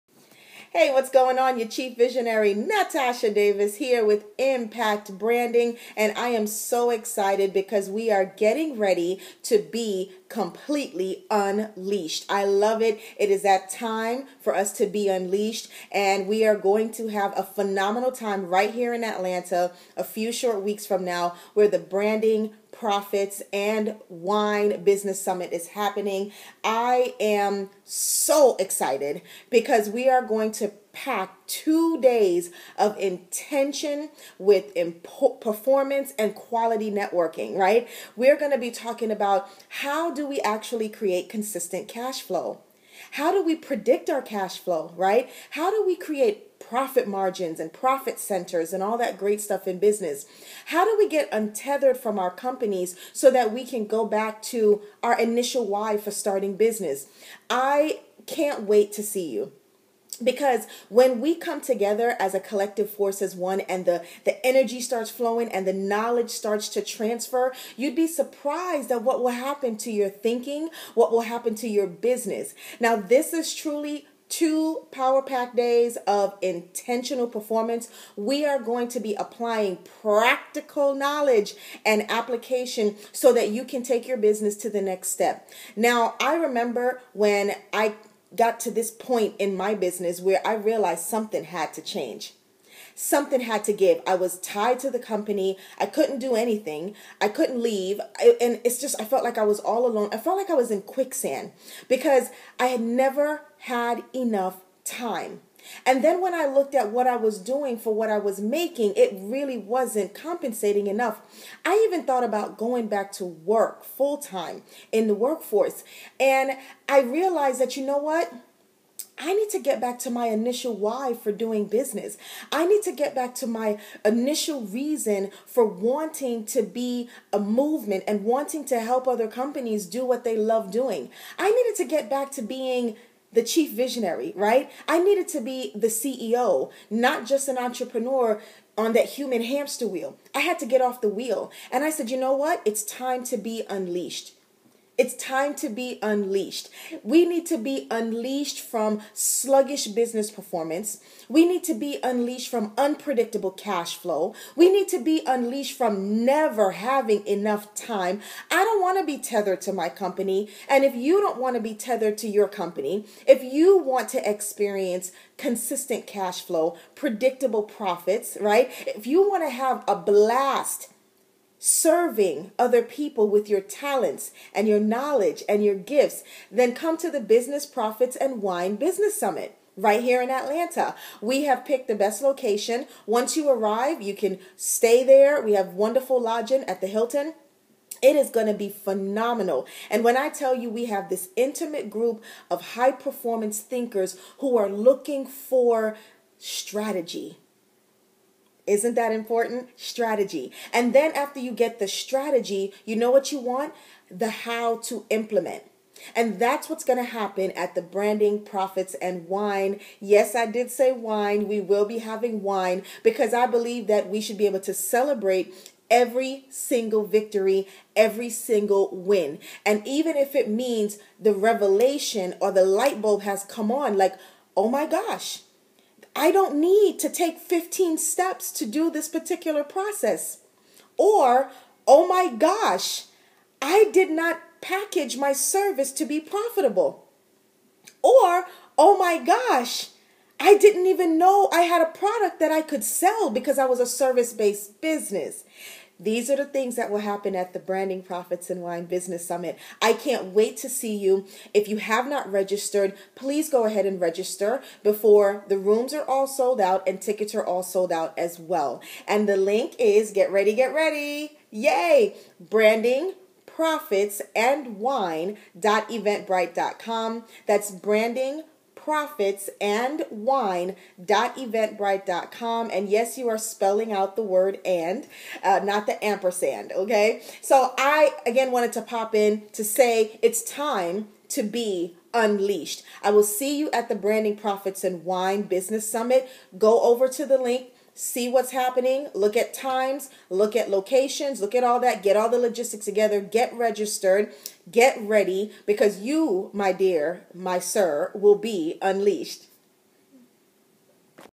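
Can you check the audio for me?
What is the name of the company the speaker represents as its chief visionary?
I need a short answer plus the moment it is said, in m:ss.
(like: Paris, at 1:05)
Impact Branding, at 0:04.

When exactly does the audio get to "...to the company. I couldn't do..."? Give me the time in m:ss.
1:34.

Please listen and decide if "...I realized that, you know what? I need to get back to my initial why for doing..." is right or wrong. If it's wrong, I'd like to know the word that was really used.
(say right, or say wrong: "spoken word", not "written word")
right.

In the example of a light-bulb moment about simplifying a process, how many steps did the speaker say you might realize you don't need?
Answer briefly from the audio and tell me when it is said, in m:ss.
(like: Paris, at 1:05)
15, at 3:47.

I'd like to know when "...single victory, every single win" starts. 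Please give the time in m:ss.
3:36.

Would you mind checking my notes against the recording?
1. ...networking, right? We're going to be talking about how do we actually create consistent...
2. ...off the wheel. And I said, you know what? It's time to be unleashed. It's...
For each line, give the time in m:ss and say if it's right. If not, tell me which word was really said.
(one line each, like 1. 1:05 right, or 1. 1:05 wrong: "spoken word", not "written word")
1. 0:36 right
2. 2:20 right.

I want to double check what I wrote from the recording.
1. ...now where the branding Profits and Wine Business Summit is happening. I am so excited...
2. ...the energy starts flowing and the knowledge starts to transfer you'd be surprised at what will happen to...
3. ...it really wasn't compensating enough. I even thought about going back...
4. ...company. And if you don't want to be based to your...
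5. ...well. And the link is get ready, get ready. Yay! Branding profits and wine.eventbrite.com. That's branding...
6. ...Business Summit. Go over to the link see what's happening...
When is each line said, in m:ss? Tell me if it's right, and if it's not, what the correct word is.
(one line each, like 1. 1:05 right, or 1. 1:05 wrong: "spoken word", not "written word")
1. 0:21 right
2. 1:04 right
3. 1:48 right
4. 2:39 wrong: "tethered", not "based"
5. 4:18 right
6. 4:45 right.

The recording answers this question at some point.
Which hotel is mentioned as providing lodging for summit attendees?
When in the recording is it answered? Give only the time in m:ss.
3:06.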